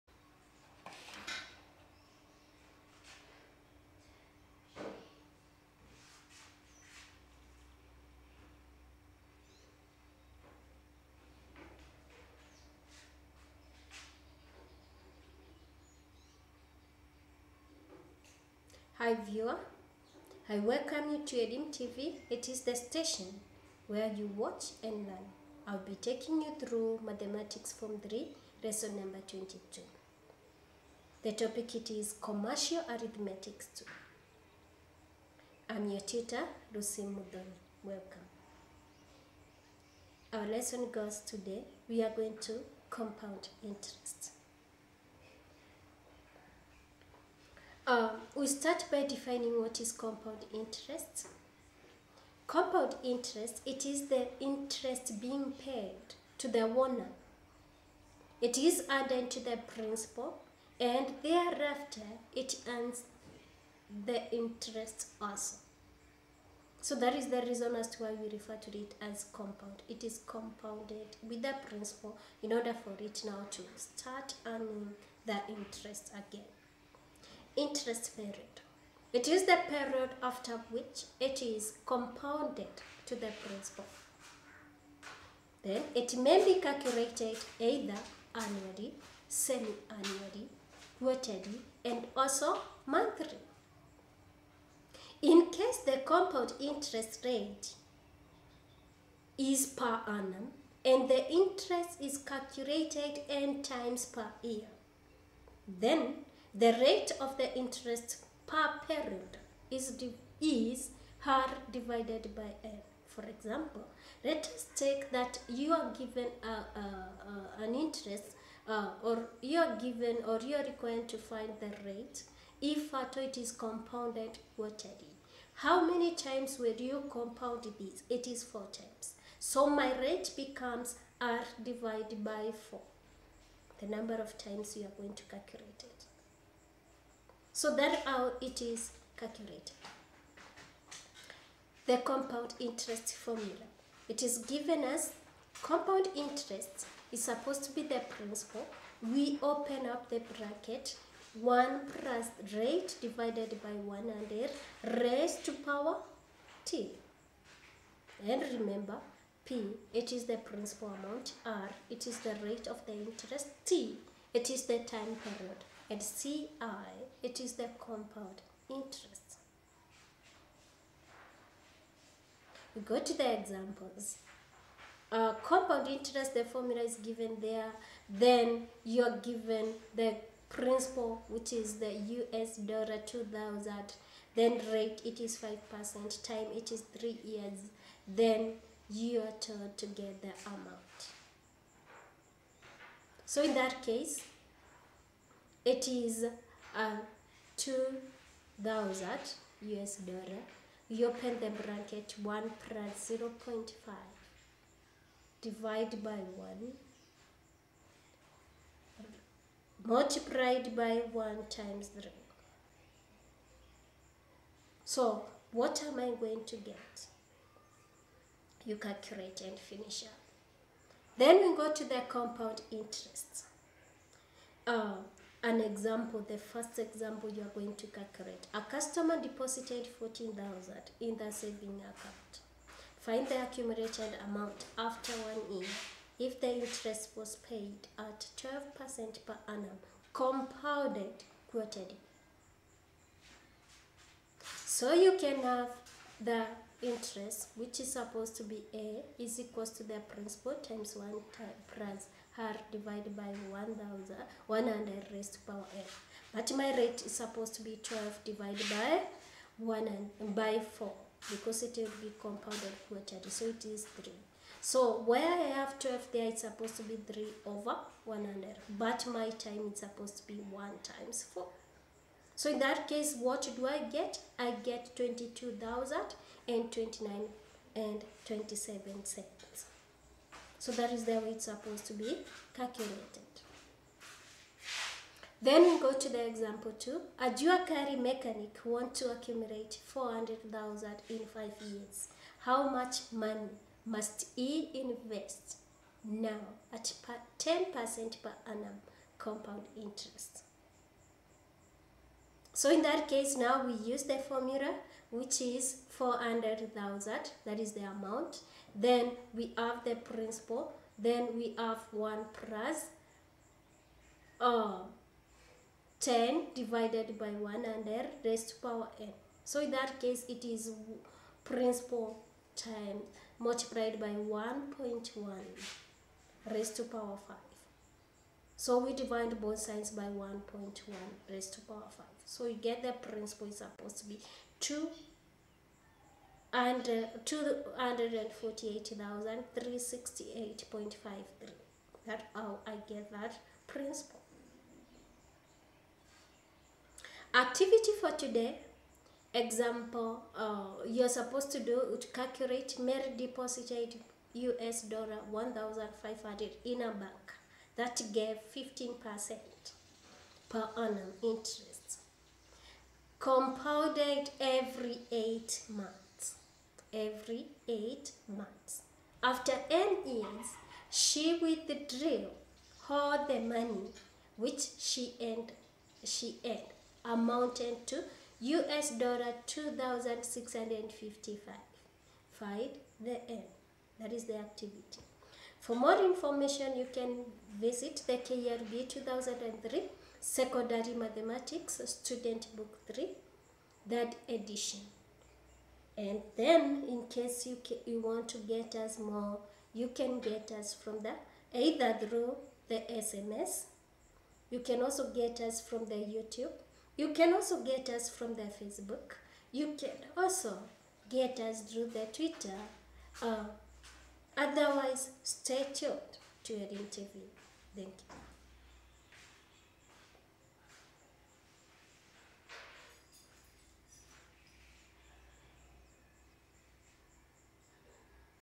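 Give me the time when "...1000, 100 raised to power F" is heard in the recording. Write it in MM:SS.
04:13.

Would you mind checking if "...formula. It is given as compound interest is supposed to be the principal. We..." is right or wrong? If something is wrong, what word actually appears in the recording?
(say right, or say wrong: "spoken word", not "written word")
right.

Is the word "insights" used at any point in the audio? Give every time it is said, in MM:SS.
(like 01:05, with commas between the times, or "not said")
not said.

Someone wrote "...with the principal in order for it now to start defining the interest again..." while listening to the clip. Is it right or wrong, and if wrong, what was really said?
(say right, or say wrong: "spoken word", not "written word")
wrong: "earning", not "defining".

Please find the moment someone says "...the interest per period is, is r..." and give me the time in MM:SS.
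01:47.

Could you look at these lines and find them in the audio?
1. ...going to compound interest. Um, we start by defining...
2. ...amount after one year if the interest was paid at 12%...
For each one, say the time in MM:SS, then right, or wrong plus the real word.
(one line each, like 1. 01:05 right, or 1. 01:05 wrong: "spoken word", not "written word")
1. 00:42 right
2. 03:54 right.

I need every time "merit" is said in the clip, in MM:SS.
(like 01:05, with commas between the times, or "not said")
05:52.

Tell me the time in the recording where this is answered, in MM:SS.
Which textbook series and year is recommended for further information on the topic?
06:28.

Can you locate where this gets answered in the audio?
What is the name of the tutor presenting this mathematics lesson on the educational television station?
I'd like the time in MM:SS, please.
00:36.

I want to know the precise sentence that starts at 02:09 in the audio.
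So my rate becomes r divided by 4, the number of times you are going to calculate it.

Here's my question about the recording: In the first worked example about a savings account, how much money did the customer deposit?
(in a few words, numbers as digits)
14,000.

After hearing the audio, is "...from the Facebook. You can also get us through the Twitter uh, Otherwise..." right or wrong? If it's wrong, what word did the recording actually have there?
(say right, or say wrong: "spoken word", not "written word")
right.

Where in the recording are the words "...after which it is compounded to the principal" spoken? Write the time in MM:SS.
01:20.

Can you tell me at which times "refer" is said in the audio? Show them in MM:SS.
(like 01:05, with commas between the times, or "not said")
01:08.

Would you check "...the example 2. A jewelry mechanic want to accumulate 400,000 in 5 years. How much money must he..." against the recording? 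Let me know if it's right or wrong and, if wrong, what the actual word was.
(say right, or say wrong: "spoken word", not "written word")
right.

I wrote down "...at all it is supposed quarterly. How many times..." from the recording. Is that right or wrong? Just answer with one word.
wrong.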